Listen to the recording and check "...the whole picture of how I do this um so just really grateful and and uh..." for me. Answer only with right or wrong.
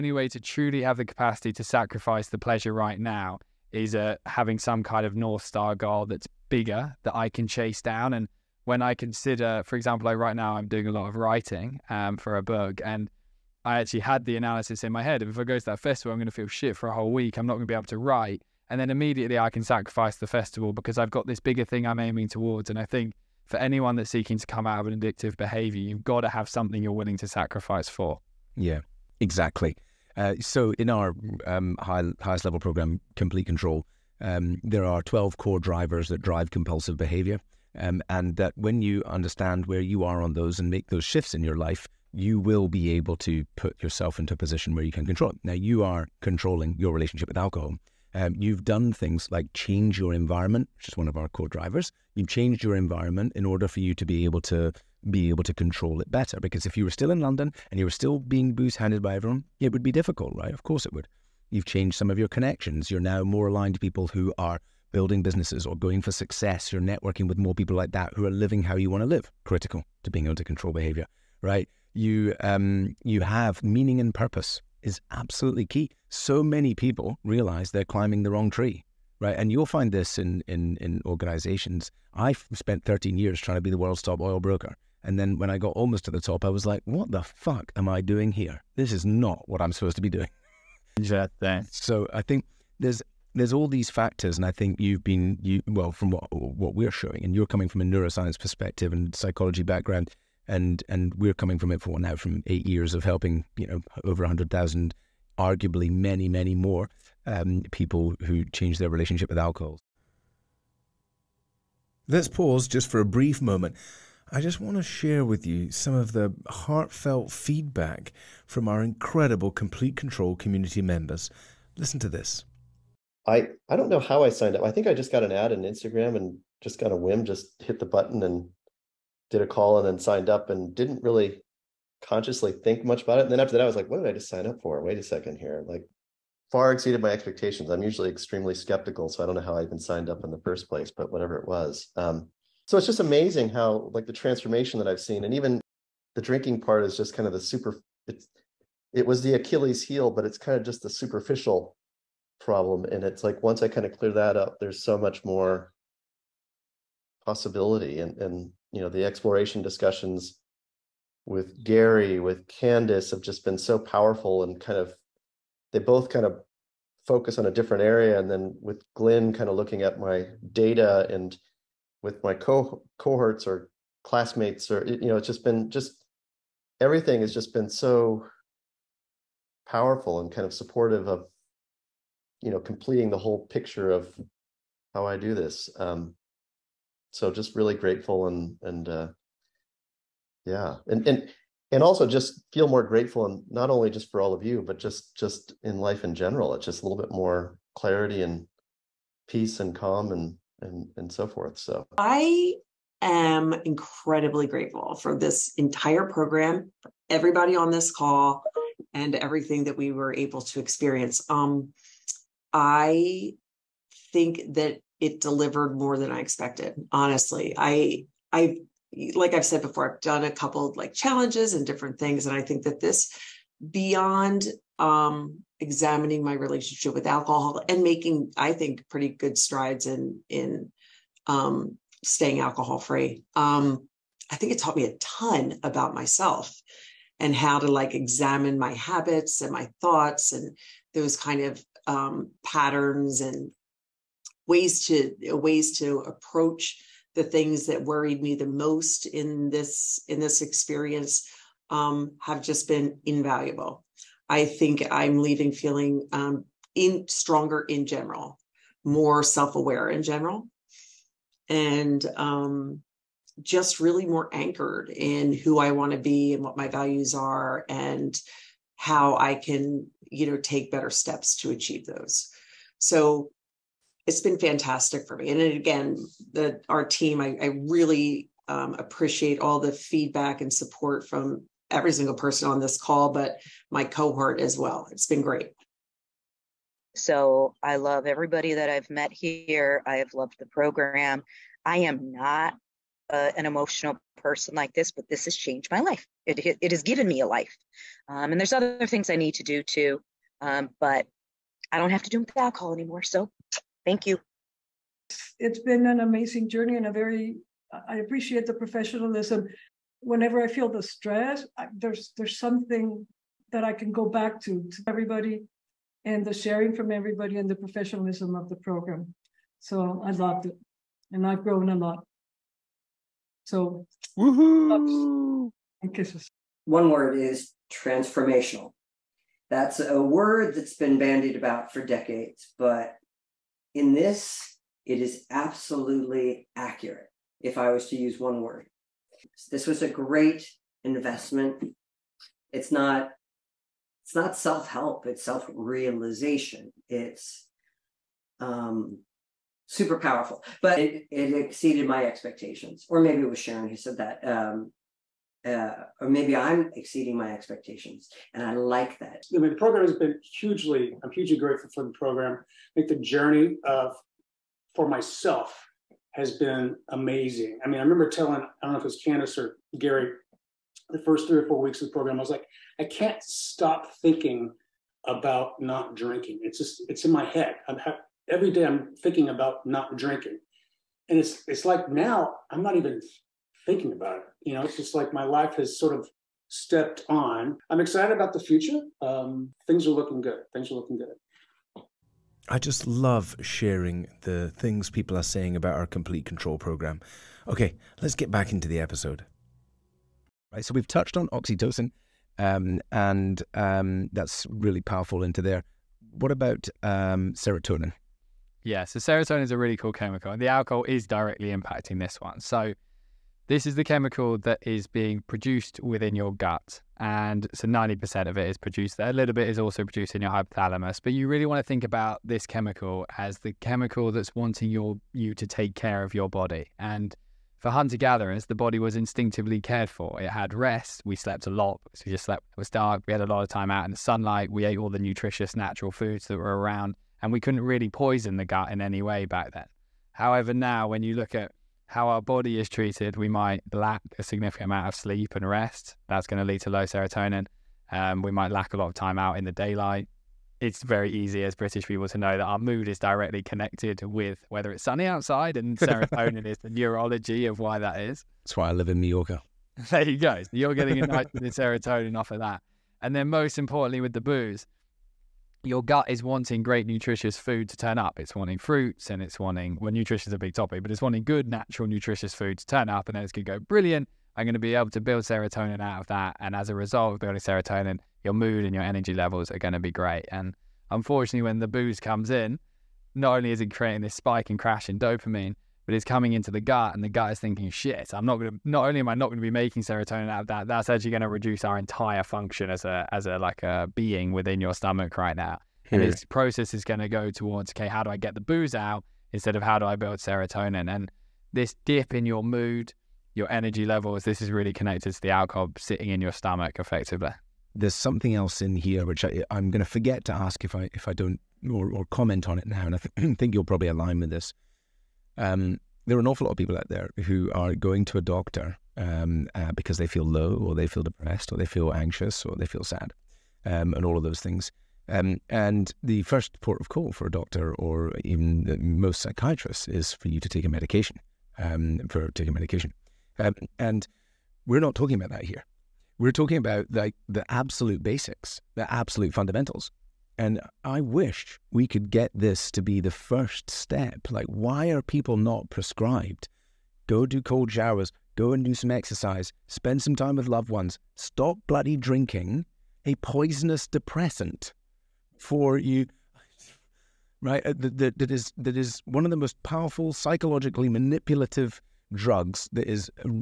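right.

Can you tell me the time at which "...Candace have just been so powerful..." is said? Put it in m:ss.
2:42.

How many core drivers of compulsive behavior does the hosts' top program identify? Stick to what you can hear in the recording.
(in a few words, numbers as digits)
12.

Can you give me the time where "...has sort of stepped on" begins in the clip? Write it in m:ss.
6:25.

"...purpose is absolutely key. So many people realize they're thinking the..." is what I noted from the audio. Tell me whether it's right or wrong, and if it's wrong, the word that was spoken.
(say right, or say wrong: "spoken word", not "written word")
wrong: "climbing", not "thinking".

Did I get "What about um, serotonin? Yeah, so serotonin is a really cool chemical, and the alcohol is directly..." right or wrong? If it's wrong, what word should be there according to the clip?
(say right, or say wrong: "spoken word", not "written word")
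right.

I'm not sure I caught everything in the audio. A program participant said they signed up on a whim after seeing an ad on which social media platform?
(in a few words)
Instagram.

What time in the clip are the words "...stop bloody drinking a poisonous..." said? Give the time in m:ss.
9:11.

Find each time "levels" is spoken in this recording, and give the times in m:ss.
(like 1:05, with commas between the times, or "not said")
0:32, 7:59, 8:23.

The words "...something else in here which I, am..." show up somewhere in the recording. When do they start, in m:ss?
8:27.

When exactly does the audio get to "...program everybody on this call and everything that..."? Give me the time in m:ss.
3:26.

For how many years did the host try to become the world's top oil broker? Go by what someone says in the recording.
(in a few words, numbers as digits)
13.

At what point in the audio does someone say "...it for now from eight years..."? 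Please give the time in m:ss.
1:41.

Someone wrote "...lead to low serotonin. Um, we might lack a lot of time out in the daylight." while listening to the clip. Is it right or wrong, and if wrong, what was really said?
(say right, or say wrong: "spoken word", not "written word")
right.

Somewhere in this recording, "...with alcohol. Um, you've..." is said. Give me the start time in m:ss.
0:47.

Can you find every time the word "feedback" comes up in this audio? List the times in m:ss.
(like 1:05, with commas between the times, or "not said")
1:57, 4:39.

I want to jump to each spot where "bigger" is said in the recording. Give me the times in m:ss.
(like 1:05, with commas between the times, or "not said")
0:06, 0:21.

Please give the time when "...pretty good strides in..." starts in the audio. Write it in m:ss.
3:48.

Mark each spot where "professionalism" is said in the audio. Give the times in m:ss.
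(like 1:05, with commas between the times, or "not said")
5:08, 5:17.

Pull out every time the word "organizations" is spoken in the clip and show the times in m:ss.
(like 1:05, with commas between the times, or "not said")
1:21.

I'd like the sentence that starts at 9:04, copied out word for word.
Like, why are people not prescribed?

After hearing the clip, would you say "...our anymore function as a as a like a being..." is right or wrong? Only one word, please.
wrong.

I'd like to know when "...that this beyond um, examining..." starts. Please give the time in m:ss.
3:42.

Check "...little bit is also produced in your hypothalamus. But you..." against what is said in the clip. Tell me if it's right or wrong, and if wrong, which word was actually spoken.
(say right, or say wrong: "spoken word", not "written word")
right.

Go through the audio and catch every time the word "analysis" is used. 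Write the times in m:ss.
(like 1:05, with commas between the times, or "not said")
0:14.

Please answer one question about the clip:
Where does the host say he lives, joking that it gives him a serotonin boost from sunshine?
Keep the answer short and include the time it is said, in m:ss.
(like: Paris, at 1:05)
Mallorca, at 7:39.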